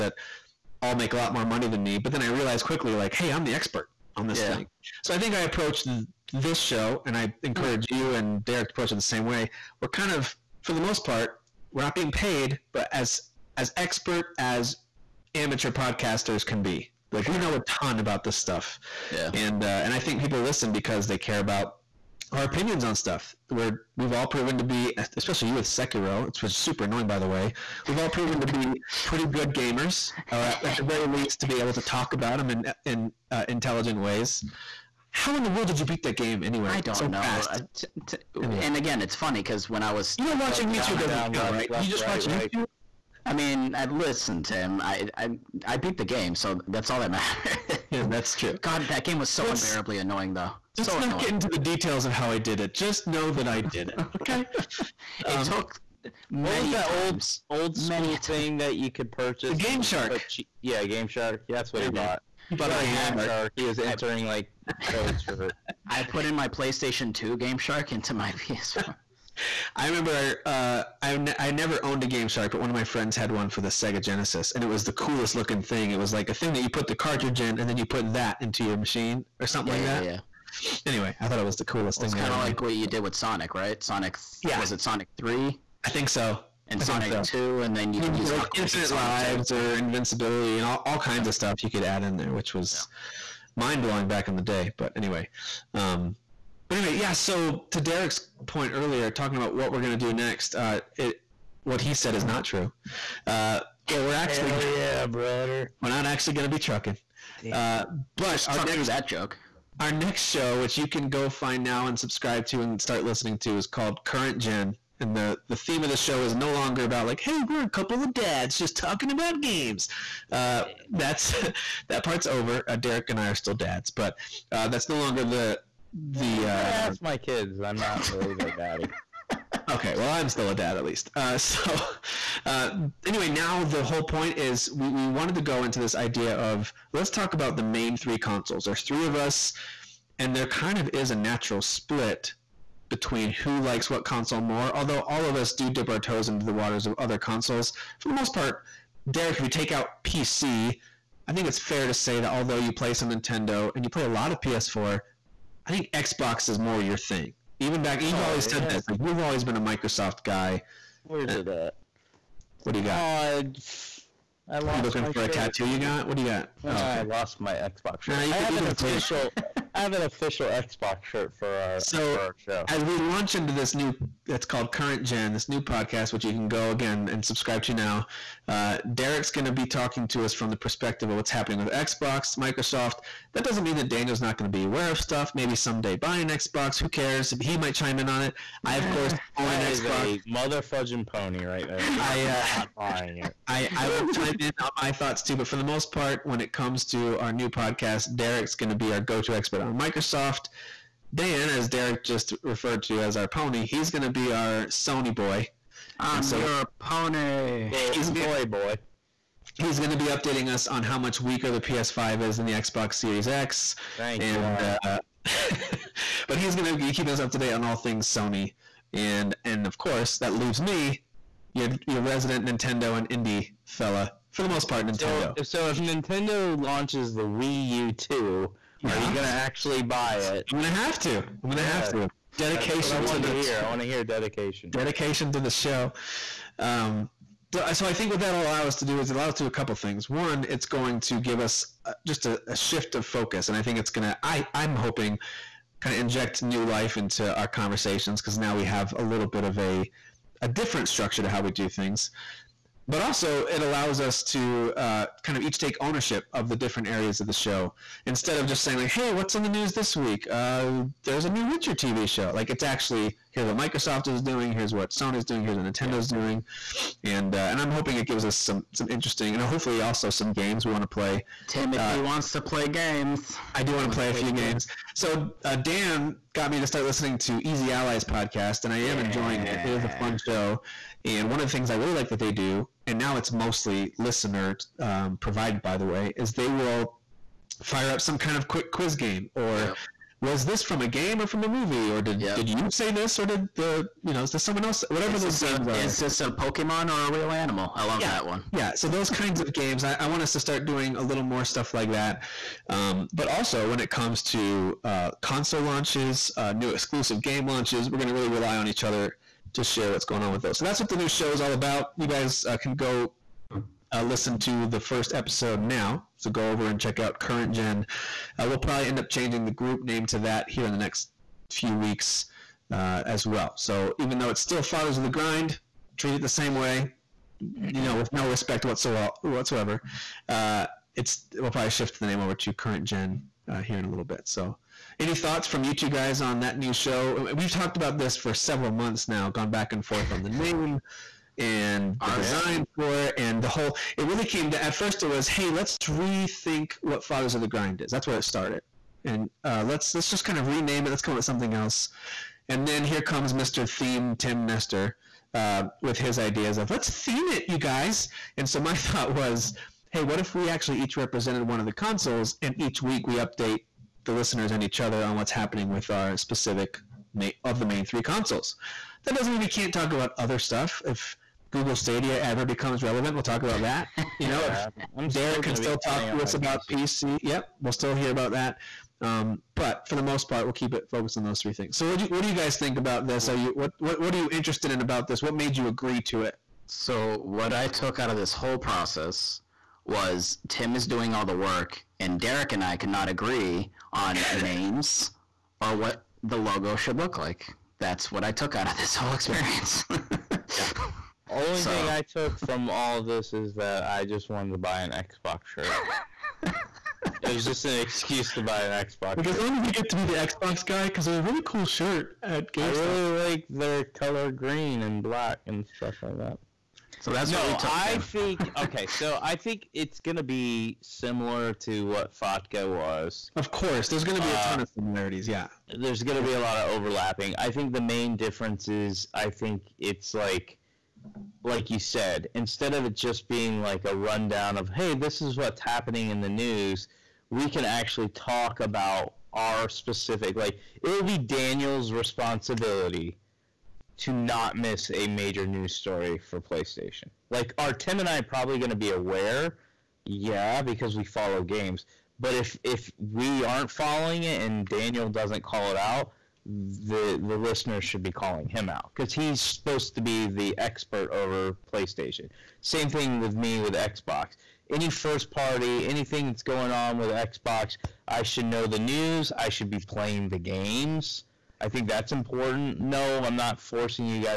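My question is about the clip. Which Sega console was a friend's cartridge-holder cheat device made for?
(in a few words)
Sega Genesis.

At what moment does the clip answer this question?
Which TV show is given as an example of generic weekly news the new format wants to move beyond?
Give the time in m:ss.
4:21.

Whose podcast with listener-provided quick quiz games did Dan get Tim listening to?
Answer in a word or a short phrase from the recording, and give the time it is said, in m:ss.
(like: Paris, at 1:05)
Easy Allies, at 4:37.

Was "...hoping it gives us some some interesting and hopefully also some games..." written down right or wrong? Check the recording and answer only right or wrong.
right.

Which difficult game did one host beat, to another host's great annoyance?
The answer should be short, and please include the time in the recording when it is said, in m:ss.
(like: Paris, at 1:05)
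Sekiro, at 0:25.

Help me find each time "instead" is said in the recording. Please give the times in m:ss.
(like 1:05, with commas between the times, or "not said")
4:18, 7:12.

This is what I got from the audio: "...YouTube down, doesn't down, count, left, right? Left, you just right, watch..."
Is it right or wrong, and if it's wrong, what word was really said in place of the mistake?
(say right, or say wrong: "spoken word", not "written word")
right.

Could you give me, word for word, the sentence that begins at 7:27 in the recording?
Like, are Tim and I probably going to be aware?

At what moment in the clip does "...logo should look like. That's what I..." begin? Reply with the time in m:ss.
6:36.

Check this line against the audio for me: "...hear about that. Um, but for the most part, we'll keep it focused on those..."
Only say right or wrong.
right.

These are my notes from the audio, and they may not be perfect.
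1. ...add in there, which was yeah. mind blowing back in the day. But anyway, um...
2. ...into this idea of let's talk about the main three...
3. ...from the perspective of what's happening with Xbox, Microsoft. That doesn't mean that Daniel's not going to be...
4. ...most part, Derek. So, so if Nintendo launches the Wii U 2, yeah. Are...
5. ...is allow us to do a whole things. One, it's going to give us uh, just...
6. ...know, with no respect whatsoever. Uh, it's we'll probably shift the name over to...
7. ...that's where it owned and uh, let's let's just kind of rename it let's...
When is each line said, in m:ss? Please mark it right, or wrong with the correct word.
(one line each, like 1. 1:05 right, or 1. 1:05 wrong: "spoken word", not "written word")
1. 1:31 right
2. 2:15 right
3. 3:00 right
4. 3:44 wrong: "Nintendo", not "Derek"
5. 3:58 wrong: "couple", not "whole"
6. 5:27 right
7. 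5:47 wrong: "started", not "owned".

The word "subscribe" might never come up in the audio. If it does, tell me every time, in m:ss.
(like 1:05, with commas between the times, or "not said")
1:51, 2:57.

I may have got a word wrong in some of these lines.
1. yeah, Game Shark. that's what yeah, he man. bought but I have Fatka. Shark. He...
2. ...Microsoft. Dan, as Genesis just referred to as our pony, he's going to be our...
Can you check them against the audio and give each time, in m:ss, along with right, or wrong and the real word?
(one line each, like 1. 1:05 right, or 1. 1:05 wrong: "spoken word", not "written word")
1. 1:00 wrong: "Shark", not "Fatka"
2. 3:19 wrong: "Derek", not "Genesis".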